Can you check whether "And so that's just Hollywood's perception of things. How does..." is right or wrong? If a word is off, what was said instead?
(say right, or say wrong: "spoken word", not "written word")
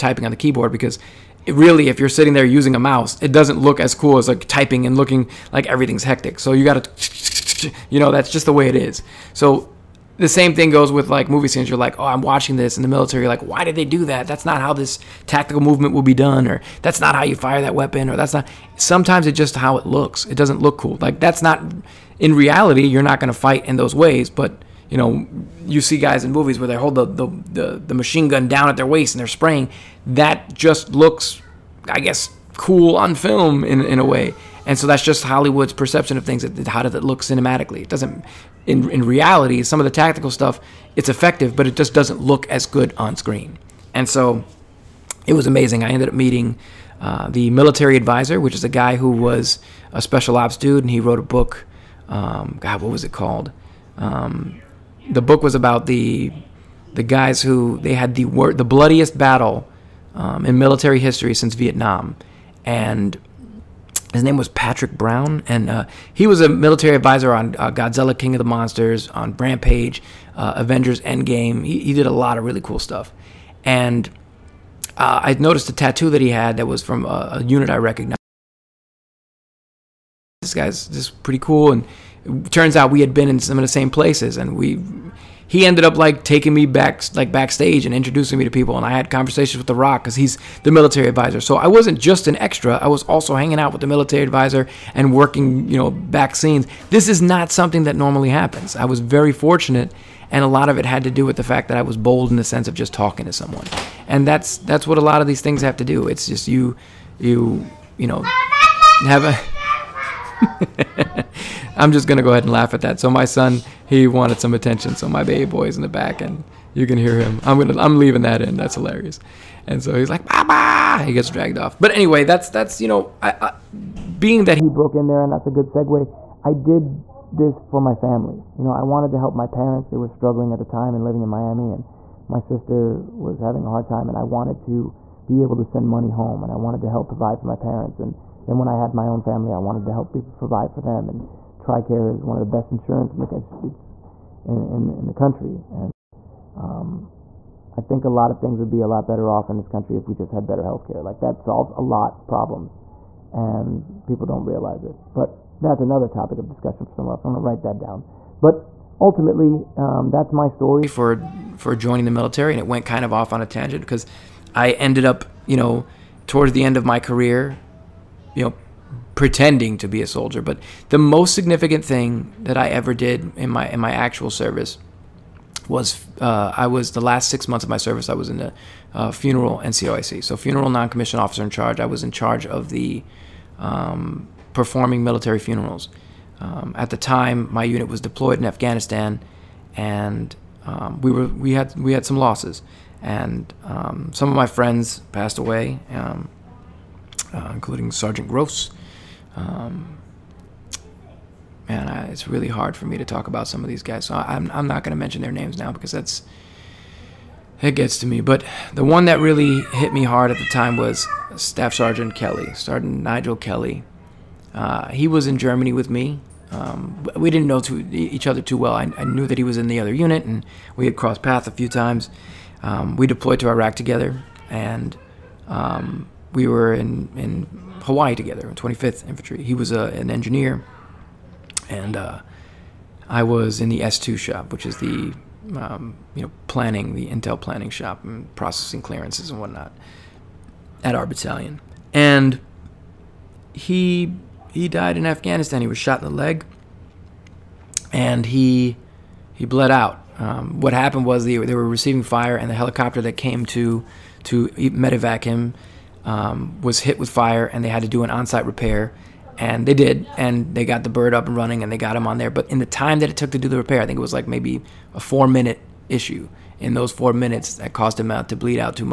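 right.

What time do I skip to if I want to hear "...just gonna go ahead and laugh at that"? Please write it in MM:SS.
01:51.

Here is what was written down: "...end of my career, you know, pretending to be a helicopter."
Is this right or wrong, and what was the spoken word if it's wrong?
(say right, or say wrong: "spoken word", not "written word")
wrong: "soldier", not "helicopter".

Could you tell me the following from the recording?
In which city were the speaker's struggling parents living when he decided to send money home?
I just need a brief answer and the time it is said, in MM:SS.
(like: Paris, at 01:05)
Miami, at 02:11.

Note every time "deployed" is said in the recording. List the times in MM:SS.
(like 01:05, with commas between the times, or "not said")
03:08, 03:43.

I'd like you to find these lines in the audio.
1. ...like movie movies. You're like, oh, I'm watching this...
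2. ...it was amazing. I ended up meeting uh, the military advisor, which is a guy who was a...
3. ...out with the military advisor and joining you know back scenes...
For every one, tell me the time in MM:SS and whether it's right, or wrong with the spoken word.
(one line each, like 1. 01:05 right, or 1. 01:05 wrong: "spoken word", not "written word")
1. 00:11 wrong: "scenes", not "movies"
2. 00:45 right
3. 01:33 wrong: "working", not "joining".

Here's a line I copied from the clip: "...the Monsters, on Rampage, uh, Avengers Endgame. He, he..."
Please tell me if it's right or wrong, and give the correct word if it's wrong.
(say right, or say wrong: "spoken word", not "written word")
right.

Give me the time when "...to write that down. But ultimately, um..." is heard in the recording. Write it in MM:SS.
02:37.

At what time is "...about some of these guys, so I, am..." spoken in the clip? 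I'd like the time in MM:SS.
03:23.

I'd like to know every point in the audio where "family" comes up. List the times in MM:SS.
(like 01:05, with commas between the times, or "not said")
02:07, 02:19.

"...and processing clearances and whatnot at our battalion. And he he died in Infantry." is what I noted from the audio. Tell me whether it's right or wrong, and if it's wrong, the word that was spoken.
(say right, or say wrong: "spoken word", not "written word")
wrong: "Afghanistan", not "Infantry".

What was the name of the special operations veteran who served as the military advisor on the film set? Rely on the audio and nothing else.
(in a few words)
Patrick Brown.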